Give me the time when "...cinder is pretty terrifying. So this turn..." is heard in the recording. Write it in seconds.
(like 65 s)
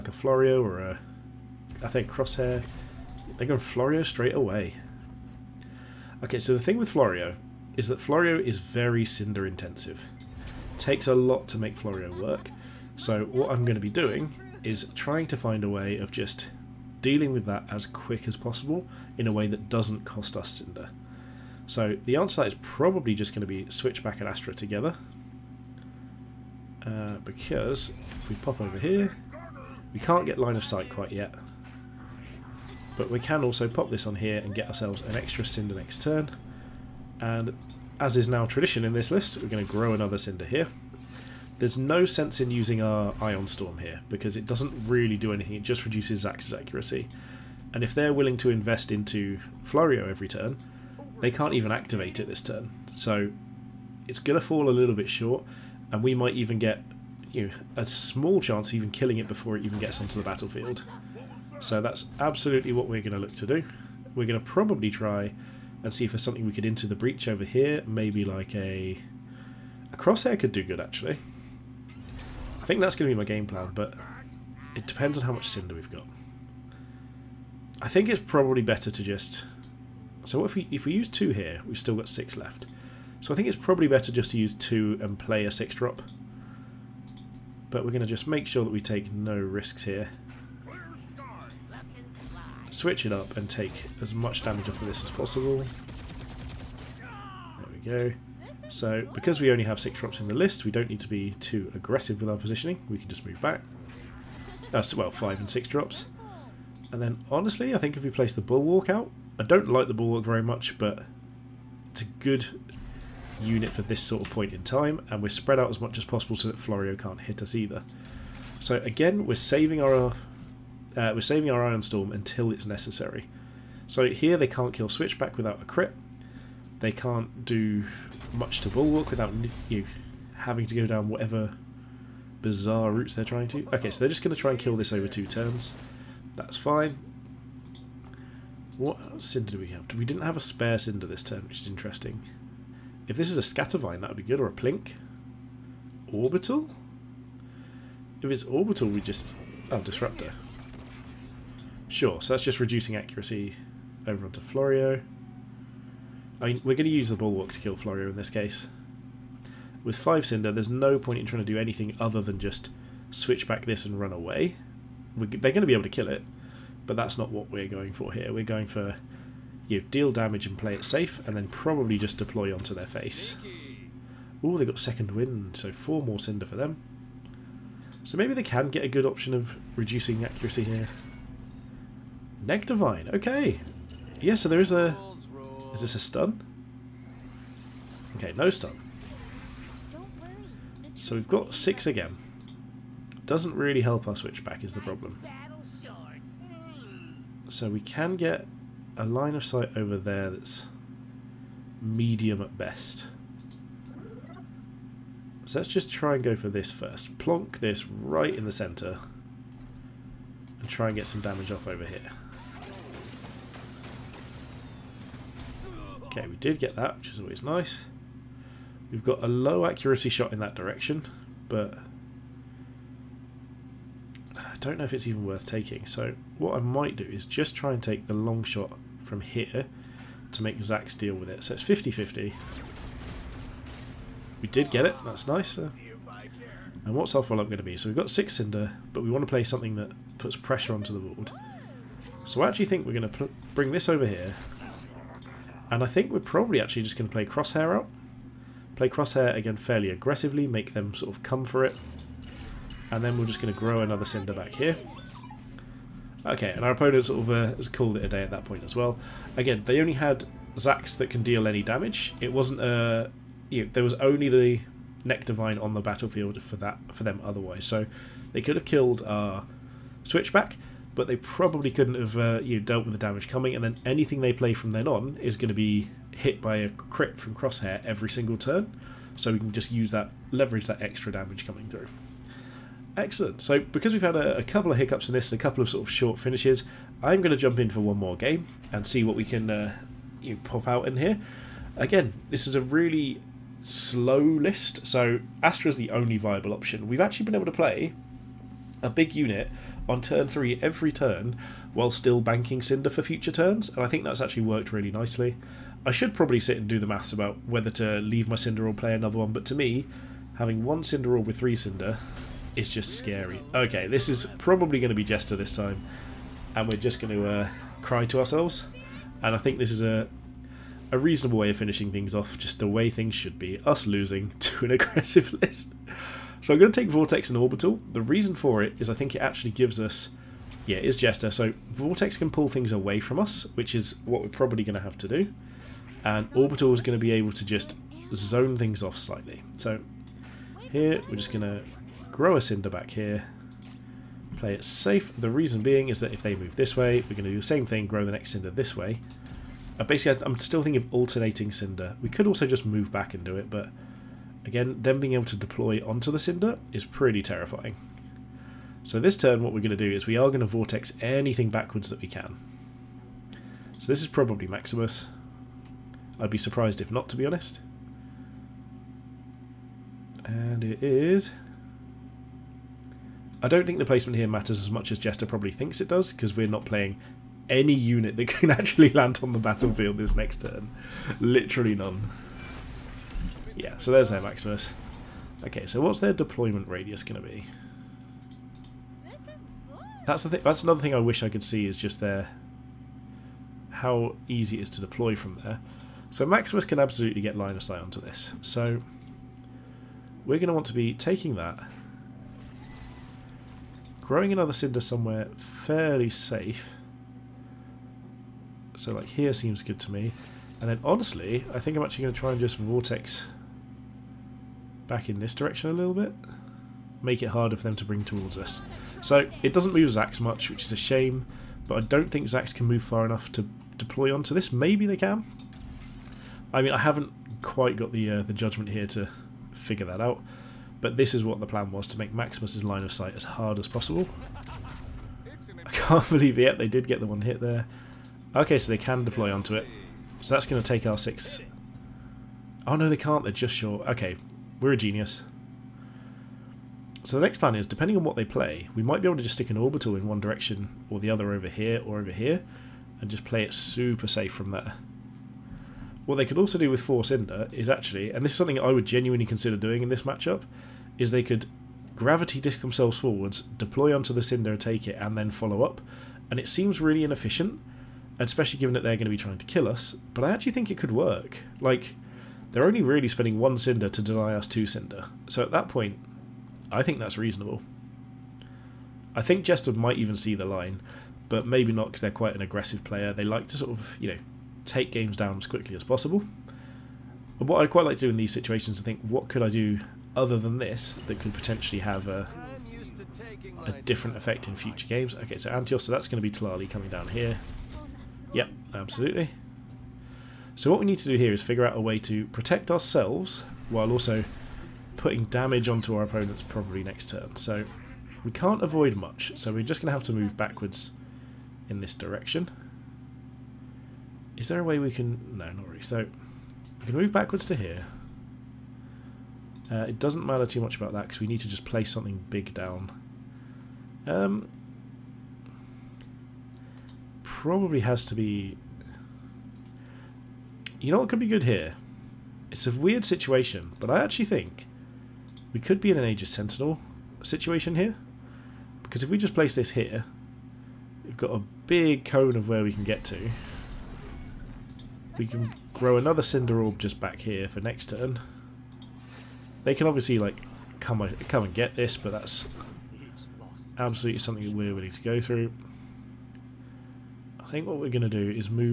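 356 s.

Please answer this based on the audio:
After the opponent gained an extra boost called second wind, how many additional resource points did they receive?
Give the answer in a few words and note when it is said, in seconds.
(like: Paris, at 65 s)
4, at 175 s.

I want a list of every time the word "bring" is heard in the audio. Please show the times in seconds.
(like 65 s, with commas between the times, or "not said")
243 s, 417 s.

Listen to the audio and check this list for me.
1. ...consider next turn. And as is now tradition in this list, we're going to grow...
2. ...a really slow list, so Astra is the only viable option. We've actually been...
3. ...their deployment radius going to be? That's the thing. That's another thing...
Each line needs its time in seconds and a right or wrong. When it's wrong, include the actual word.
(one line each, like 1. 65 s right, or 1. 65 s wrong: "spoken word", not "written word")
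1. 35 s wrong: "cinder", not "consider"
2. 292 s right
3. 386 s right.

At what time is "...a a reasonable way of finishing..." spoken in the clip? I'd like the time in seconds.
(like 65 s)
319 s.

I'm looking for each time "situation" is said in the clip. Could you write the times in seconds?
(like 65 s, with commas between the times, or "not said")
488 s, 533 s, 537 s.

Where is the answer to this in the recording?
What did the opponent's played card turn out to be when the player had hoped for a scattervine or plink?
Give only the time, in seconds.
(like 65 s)
149 s.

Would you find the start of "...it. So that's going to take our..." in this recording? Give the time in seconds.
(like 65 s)
439 s.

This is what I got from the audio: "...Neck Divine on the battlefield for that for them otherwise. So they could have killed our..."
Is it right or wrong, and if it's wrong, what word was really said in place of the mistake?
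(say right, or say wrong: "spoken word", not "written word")
right.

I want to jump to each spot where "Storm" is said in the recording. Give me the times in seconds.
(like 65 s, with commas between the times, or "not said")
43 s, 121 s.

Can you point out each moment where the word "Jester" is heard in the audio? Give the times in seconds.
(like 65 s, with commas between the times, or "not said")
315 s, 330 s, 374 s, 479 s.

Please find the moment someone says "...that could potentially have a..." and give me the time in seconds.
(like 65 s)
491 s.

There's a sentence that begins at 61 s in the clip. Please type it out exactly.
So that's absolutely what we're going to look to do.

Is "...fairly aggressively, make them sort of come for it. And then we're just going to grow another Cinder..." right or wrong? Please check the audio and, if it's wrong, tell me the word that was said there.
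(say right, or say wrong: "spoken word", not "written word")
right.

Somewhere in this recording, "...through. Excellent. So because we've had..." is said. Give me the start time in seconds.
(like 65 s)
281 s.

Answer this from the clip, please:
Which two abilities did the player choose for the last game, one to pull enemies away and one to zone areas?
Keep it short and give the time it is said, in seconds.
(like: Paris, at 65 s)
Vortex and Orbital, at 326 s.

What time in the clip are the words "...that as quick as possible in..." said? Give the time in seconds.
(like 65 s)
17 s.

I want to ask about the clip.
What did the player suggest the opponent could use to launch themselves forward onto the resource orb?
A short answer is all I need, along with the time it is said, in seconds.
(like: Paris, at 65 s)
gravity disk, at 461 s.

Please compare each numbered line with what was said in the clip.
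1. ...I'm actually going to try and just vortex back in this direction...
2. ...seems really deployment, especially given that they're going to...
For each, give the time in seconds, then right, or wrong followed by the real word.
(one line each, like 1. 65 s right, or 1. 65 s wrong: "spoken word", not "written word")
1. 411 s right
2. 466 s wrong: "inefficient", not "deployment".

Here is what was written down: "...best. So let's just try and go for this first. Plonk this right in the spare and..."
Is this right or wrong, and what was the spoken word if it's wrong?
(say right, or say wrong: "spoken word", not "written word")
wrong: "centre", not "spare".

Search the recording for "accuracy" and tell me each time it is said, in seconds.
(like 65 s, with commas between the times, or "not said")
46 s, 152 s, 180 s, 219 s.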